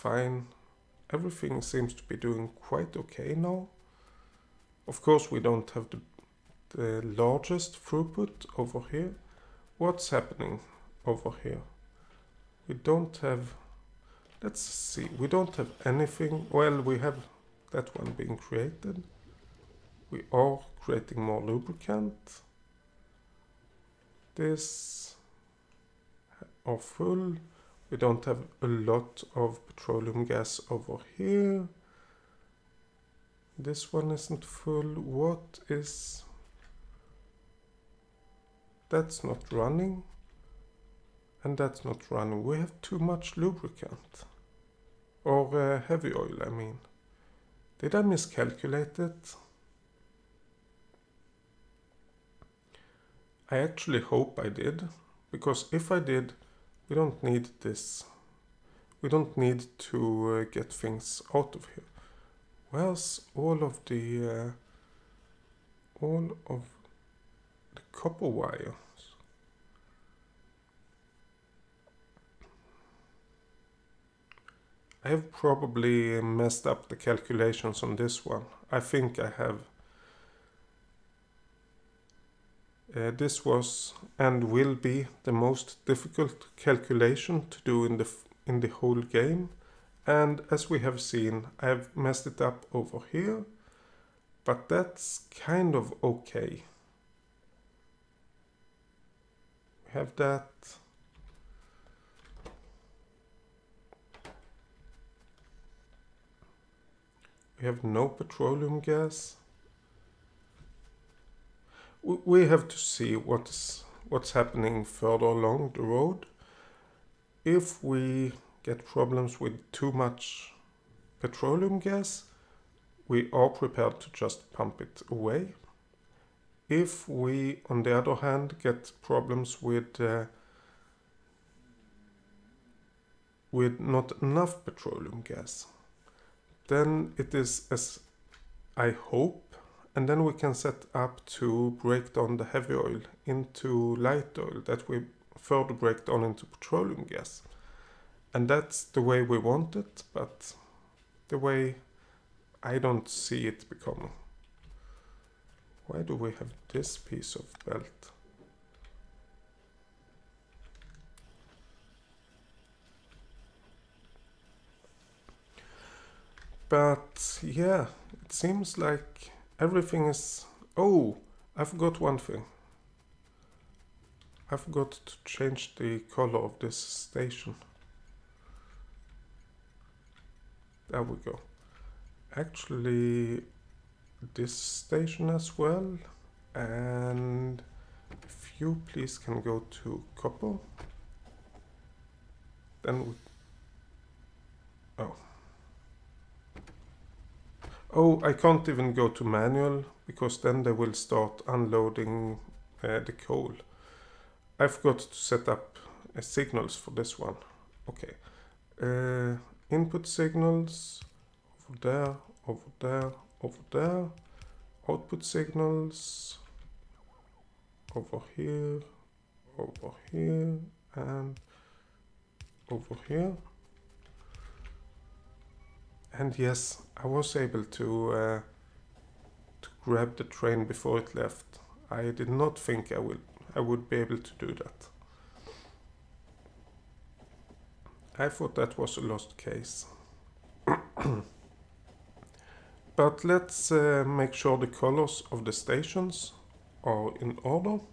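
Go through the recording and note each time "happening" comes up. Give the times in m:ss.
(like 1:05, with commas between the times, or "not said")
0:10, 1:54.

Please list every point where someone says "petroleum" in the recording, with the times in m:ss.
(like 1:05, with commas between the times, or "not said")
0:29, 1:48, 2:01, 2:14, 2:26.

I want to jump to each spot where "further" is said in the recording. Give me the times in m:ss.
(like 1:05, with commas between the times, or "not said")
1:54, 2:25.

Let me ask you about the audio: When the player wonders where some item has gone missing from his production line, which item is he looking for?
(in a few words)
Copper wire.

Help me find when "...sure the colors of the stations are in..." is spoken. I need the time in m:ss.
4:04.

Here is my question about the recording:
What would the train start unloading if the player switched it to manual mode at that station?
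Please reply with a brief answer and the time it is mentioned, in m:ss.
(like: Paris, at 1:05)
Coal, at 3:23.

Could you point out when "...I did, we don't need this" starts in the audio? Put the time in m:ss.
0:55.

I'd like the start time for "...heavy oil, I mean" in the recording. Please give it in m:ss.
0:45.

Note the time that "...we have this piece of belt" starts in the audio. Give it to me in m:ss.
2:36.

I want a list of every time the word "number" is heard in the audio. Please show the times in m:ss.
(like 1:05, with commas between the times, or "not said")
not said.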